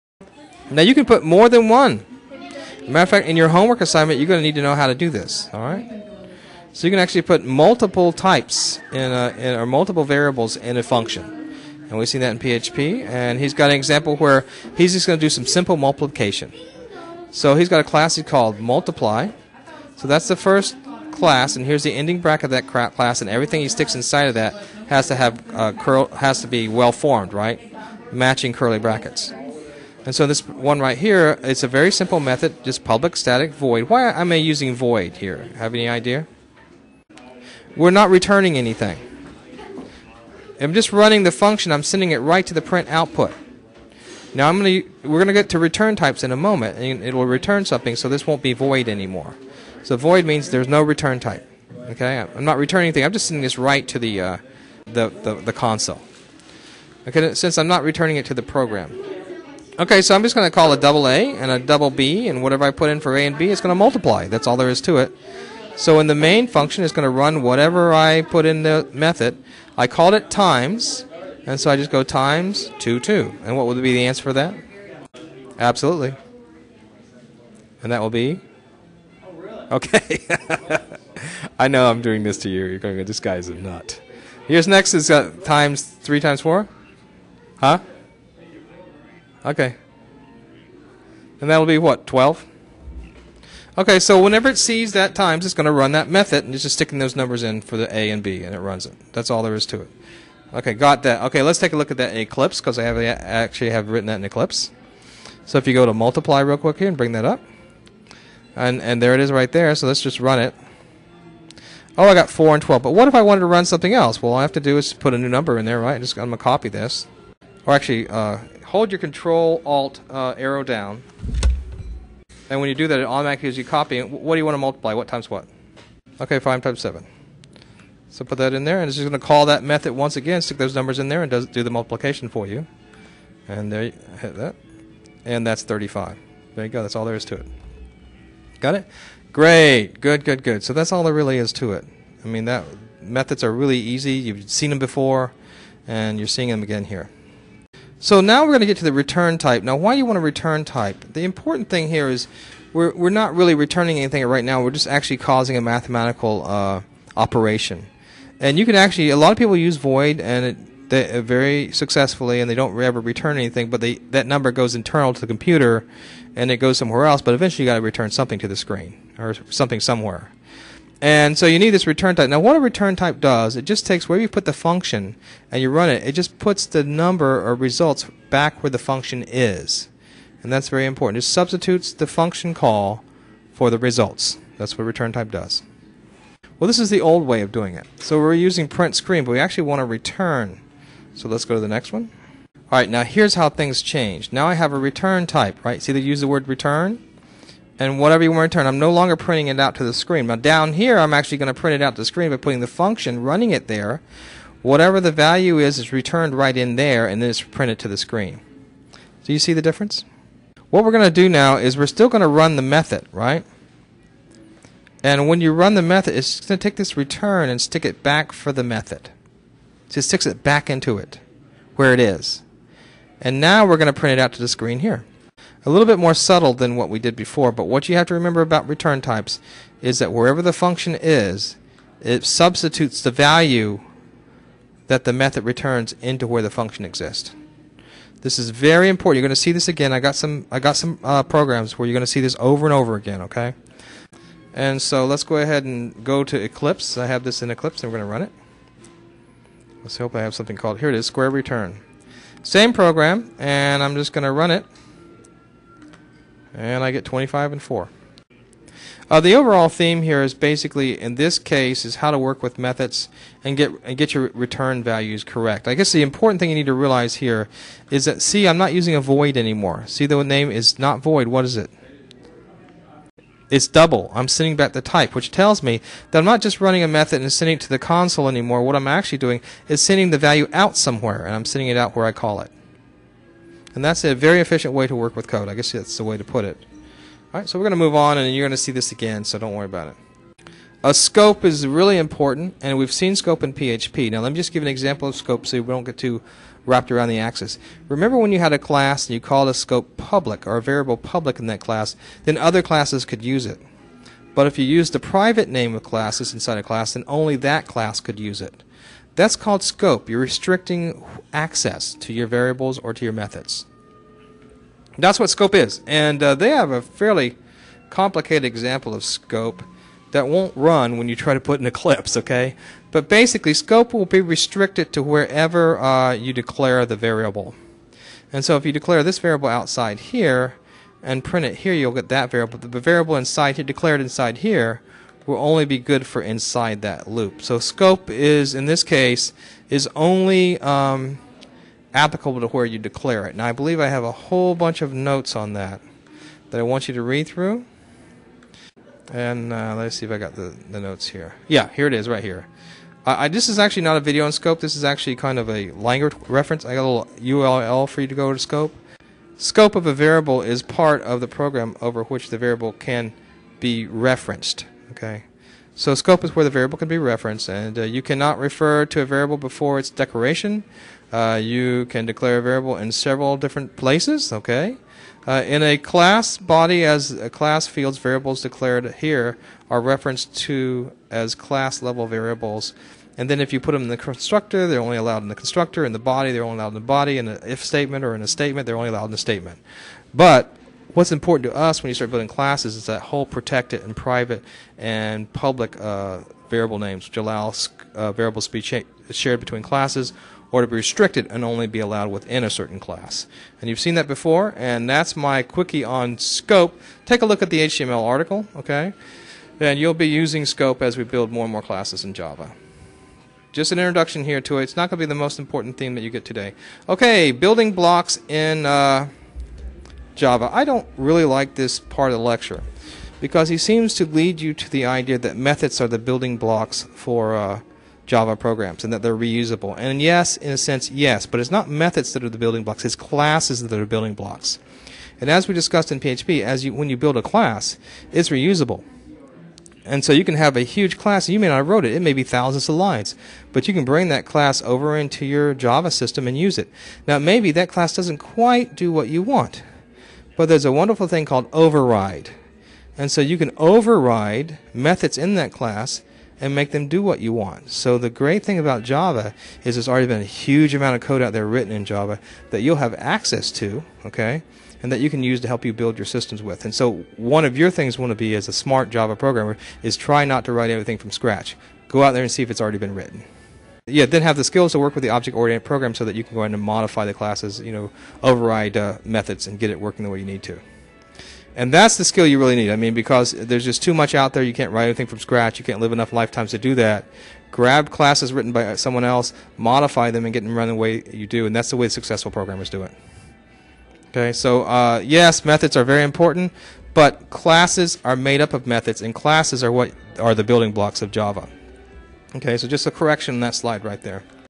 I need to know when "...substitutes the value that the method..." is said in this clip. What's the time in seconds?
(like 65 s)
232 s.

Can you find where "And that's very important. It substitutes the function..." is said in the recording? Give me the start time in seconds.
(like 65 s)
180 s.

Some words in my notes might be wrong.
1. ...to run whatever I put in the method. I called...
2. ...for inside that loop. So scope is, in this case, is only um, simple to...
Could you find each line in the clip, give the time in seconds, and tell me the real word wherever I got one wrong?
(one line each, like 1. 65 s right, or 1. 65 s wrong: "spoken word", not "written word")
1. 67 s right
2. 336 s wrong: "applicable", not "simple".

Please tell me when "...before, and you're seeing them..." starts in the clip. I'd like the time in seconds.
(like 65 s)
144 s.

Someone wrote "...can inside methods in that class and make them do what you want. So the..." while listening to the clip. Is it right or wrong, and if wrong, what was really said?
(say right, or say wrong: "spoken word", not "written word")
wrong: "override", not "inside".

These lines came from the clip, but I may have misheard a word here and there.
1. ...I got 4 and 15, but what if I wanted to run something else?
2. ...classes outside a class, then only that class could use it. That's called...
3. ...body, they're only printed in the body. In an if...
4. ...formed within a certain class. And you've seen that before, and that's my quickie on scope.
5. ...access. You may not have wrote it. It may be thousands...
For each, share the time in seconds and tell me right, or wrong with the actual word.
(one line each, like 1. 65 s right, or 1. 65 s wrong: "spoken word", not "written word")
1. 112 s wrong: "12", not "15"
2. 305 s wrong: "inside", not "outside"
3. 385 s wrong: "allowed", not "printed"
4. 401 s wrong: "allowed", not "formed"
5. 440 s wrong: "class", not "access".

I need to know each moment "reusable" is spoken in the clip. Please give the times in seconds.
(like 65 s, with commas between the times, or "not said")
429 s, 438 s.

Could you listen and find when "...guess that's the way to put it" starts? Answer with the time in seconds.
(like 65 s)
285 s.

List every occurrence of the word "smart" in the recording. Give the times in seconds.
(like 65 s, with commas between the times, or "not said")
468 s.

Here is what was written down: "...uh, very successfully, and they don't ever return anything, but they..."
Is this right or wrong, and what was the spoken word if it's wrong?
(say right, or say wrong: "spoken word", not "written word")
right.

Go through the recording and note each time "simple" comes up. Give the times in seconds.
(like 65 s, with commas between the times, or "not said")
15 s, 31 s.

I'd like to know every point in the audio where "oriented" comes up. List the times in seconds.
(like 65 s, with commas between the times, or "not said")
475 s.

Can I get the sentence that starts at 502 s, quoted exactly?
Okay, so just a correction on that slide right there.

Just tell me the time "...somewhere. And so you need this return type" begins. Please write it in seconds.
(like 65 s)
169 s.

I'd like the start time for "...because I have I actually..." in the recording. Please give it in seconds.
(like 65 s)
102 s.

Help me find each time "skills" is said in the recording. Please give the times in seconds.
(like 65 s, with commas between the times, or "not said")
474 s, 482 s.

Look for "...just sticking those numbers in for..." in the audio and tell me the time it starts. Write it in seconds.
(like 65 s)
96 s.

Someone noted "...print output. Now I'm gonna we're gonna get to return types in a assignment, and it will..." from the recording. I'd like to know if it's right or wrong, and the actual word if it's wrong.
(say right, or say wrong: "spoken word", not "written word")
wrong: "moment", not "assignment".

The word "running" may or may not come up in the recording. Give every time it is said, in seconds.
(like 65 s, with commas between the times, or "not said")
40 s, 203 s, 276 s.